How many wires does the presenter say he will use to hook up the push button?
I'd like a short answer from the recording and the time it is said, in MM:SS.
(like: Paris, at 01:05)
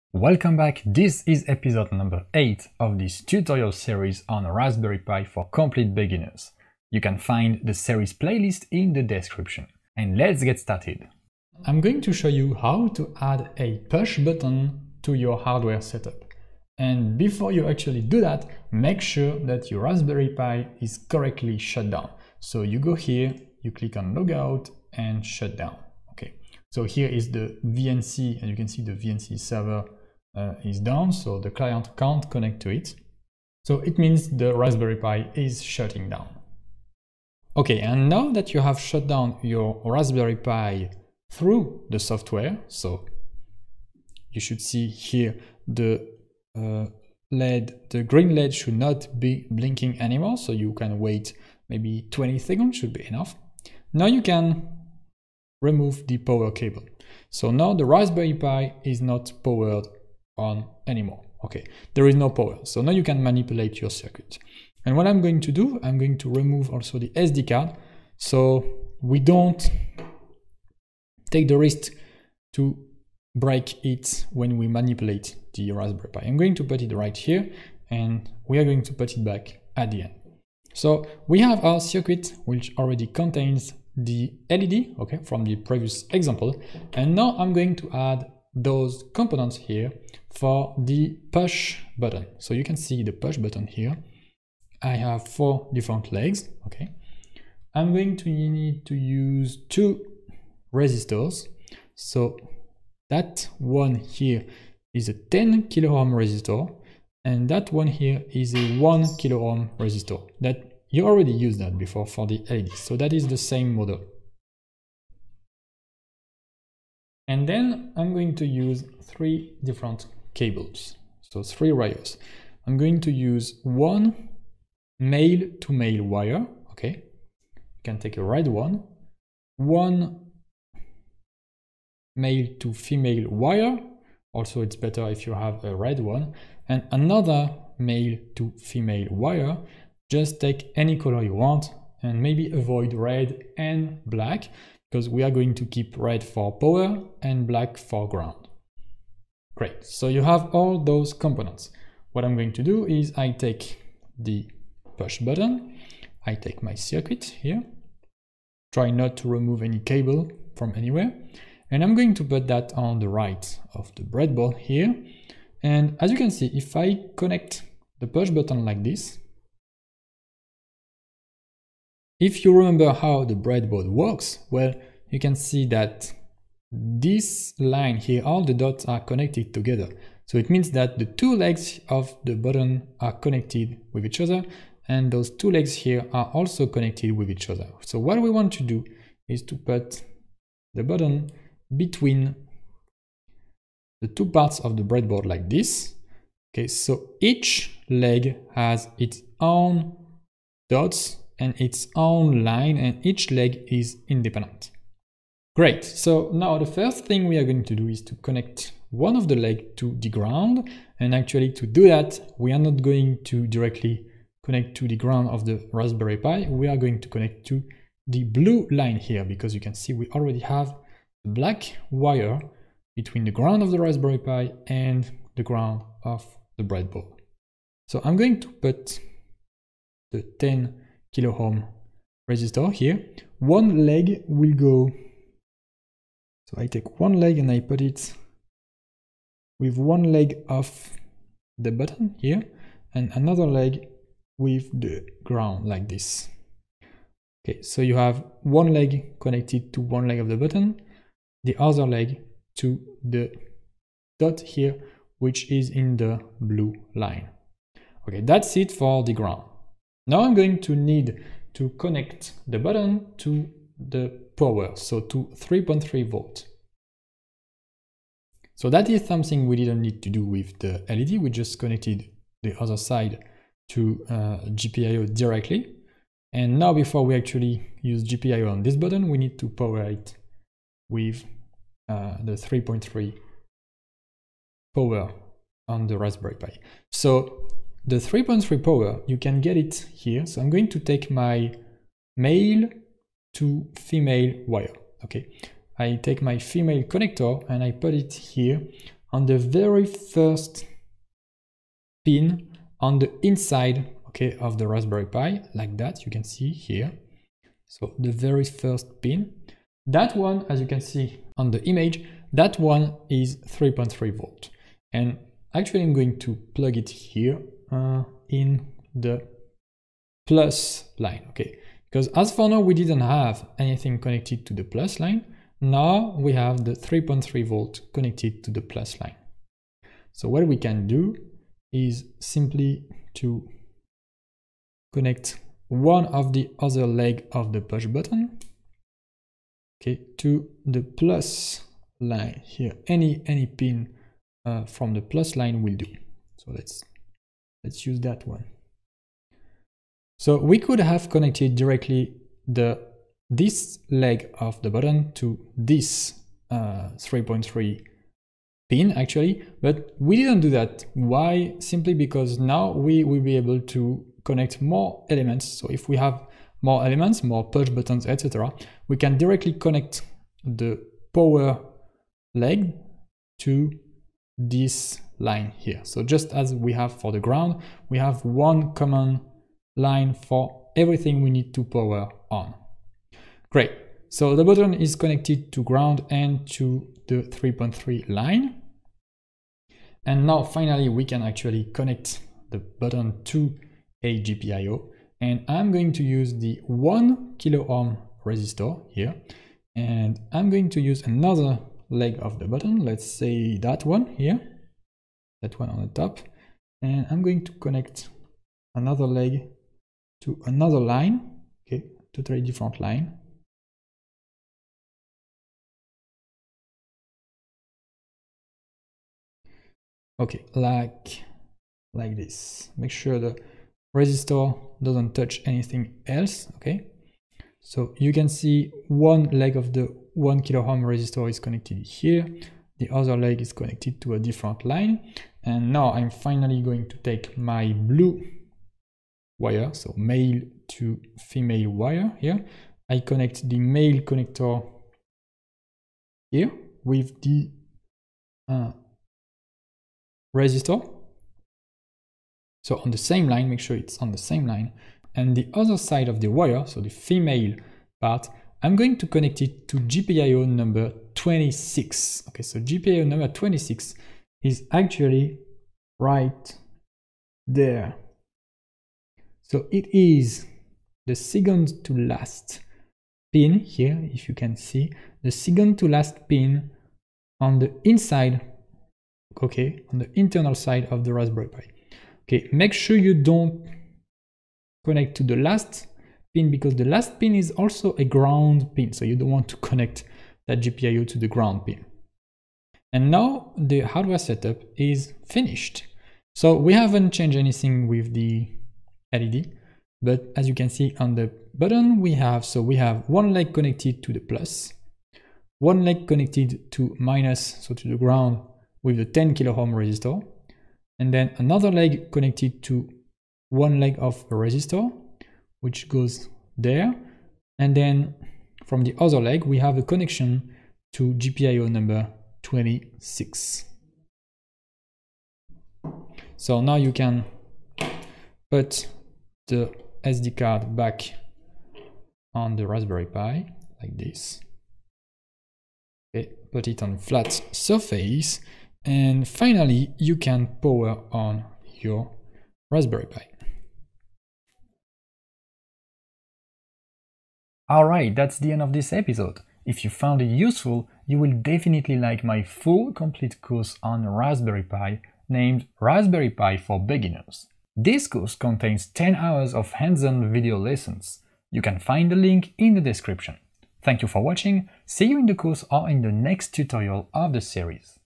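3, at 02:01.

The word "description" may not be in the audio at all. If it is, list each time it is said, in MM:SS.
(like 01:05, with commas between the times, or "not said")
00:09, 09:22.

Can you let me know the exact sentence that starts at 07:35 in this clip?
And the other side of the wire, so the female part, I'm going to connect it to GPIO number 26.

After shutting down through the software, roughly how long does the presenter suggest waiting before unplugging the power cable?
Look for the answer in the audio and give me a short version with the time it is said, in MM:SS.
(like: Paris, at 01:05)
20 seconds, at 00:52.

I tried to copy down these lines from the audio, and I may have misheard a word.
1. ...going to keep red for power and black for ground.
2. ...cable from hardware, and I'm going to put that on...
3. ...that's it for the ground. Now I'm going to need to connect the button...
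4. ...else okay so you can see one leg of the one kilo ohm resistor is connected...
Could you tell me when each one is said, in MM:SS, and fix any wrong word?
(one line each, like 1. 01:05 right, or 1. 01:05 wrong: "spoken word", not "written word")
1. 02:25 right
2. 02:39 wrong: "anywhere", not "hardware"
3. 04:18 right
4. 07:06 right.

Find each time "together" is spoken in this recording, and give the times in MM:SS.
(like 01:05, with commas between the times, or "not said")
02:59.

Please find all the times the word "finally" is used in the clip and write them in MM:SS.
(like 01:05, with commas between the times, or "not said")
06:30, 07:16, 08:59.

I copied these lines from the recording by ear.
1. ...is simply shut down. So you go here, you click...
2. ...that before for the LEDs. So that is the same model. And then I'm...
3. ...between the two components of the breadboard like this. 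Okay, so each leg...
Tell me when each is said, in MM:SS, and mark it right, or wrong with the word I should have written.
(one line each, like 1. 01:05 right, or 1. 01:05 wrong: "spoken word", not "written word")
1. 00:20 wrong: "correctly", not "simply"
2. 01:51 right
3. 03:11 wrong: "parts", not "components".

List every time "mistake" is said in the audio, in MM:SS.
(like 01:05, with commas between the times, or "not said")
not said.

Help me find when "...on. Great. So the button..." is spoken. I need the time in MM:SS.
06:22.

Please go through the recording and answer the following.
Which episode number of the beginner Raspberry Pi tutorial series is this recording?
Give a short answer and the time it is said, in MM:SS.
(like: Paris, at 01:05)
8, at 00:01.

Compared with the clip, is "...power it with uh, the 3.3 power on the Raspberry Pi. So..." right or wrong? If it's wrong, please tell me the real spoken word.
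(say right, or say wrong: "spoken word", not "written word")
right.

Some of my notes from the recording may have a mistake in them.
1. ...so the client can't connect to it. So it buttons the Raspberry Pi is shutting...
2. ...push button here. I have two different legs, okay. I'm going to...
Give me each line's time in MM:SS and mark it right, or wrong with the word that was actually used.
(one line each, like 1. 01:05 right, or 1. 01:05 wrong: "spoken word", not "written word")
1. 00:31 wrong: "means", not "buttons"
2. 01:33 wrong: "four", not "two".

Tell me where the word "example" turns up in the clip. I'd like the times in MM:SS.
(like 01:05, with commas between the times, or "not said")
01:26.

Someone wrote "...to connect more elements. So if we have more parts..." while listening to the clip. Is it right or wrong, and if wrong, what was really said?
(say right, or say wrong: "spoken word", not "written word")
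wrong: "elements", not "parts".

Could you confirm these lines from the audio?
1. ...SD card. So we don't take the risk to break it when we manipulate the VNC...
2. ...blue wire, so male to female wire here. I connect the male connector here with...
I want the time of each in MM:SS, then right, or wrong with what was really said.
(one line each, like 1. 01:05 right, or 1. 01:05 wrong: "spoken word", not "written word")
1. 01:07 wrong: "Raspberry", not "VNC"
2. 07:17 right.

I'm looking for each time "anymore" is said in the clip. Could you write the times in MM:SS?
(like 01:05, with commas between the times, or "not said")
00:50, 01:00.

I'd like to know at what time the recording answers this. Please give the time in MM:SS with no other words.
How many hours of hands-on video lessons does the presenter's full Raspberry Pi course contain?
09:18.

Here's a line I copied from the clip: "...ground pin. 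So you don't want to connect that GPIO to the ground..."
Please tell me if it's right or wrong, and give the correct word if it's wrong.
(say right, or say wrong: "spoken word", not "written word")
right.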